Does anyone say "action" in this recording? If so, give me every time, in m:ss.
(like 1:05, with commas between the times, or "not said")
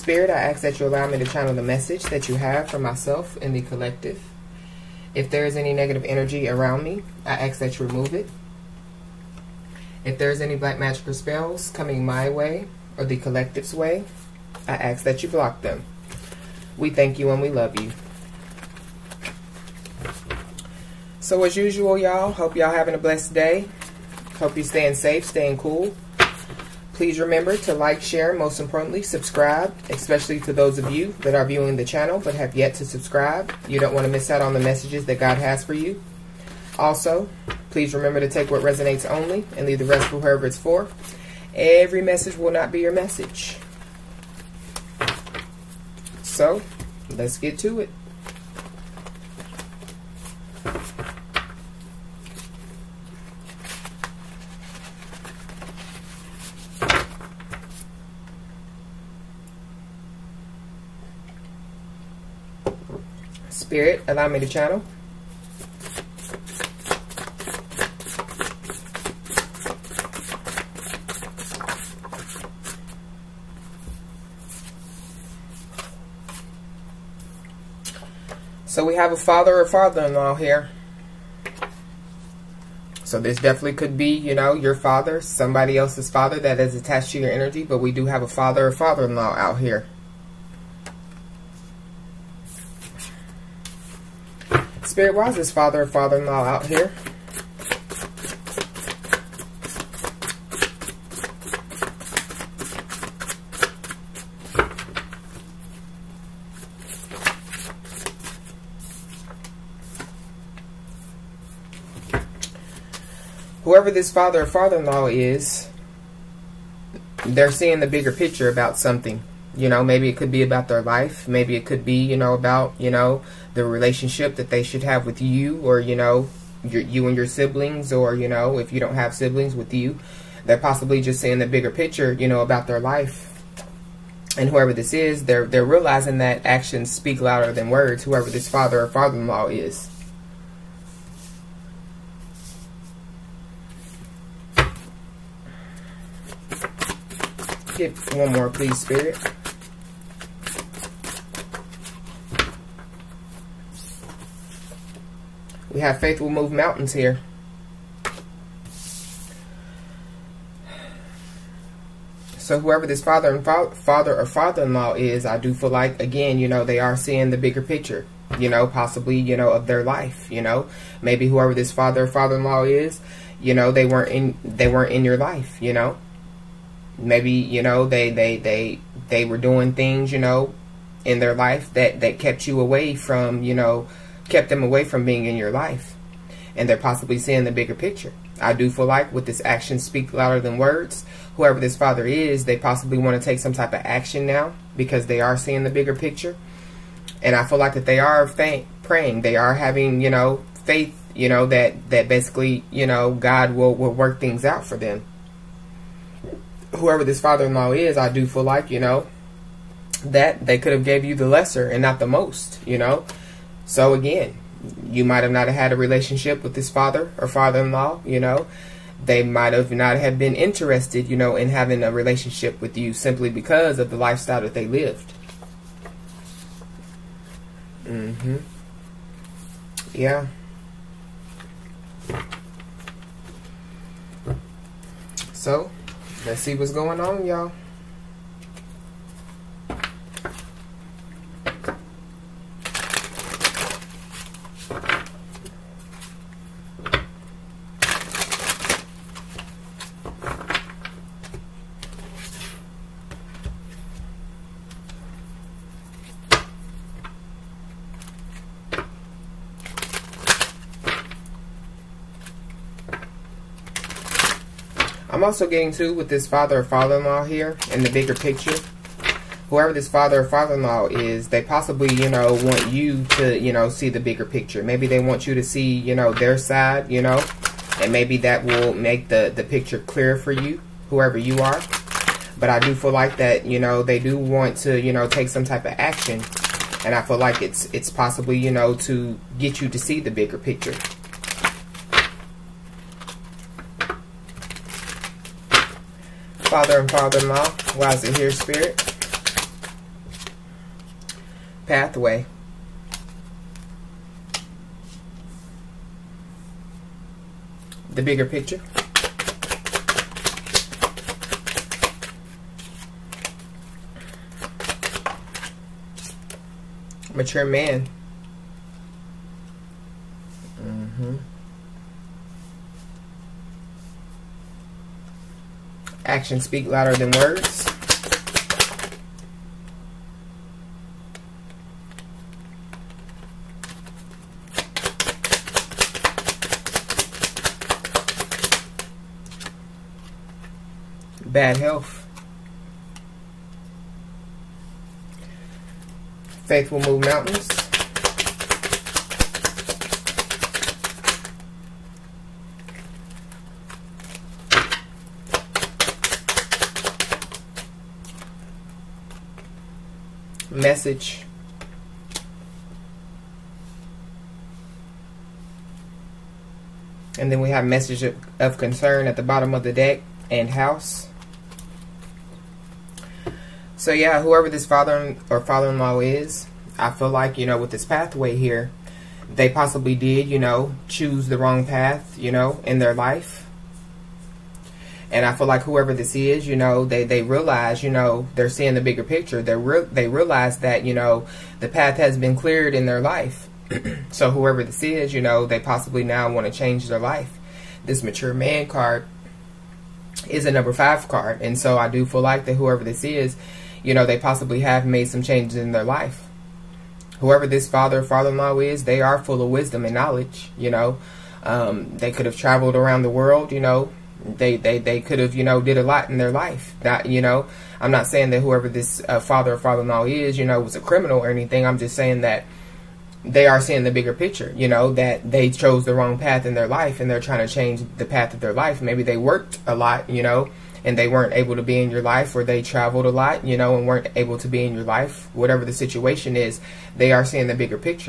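2:16, 3:09, 3:13, 4:45, 5:26.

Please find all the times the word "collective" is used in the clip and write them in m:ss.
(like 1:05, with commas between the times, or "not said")
0:03, 0:13.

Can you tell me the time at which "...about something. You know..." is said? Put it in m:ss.
1:58.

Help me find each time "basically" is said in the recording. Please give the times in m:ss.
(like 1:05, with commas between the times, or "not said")
3:22.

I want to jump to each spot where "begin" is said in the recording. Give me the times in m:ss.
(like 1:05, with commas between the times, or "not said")
not said.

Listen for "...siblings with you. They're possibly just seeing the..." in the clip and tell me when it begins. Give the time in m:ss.
2:09.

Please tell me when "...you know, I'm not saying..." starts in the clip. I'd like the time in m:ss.
6:57.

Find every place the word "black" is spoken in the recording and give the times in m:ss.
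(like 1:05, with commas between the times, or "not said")
0:10.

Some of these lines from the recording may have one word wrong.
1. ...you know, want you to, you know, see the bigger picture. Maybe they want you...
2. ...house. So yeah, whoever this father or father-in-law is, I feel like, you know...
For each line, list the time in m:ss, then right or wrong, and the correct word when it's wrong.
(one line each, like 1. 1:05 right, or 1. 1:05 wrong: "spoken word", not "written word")
1. 4:31 right
2. 6:10 right.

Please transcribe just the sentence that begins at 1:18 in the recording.
So we have a father or father-in-law here.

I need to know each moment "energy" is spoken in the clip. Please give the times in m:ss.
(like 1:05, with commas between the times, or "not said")
0:06, 1:27.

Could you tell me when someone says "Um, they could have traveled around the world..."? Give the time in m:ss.
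6:51.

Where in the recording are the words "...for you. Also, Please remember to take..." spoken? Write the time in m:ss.
0:35.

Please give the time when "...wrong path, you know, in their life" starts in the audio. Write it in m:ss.
6:21.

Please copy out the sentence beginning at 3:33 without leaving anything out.
So again, you might have not had a relationship with this father or father-in-law, you know.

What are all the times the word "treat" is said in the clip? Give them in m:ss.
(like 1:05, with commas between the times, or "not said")
not said.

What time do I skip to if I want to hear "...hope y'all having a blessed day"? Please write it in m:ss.
0:22.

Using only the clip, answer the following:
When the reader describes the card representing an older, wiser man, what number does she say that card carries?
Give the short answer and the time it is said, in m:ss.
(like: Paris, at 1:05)
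5, at 6:40.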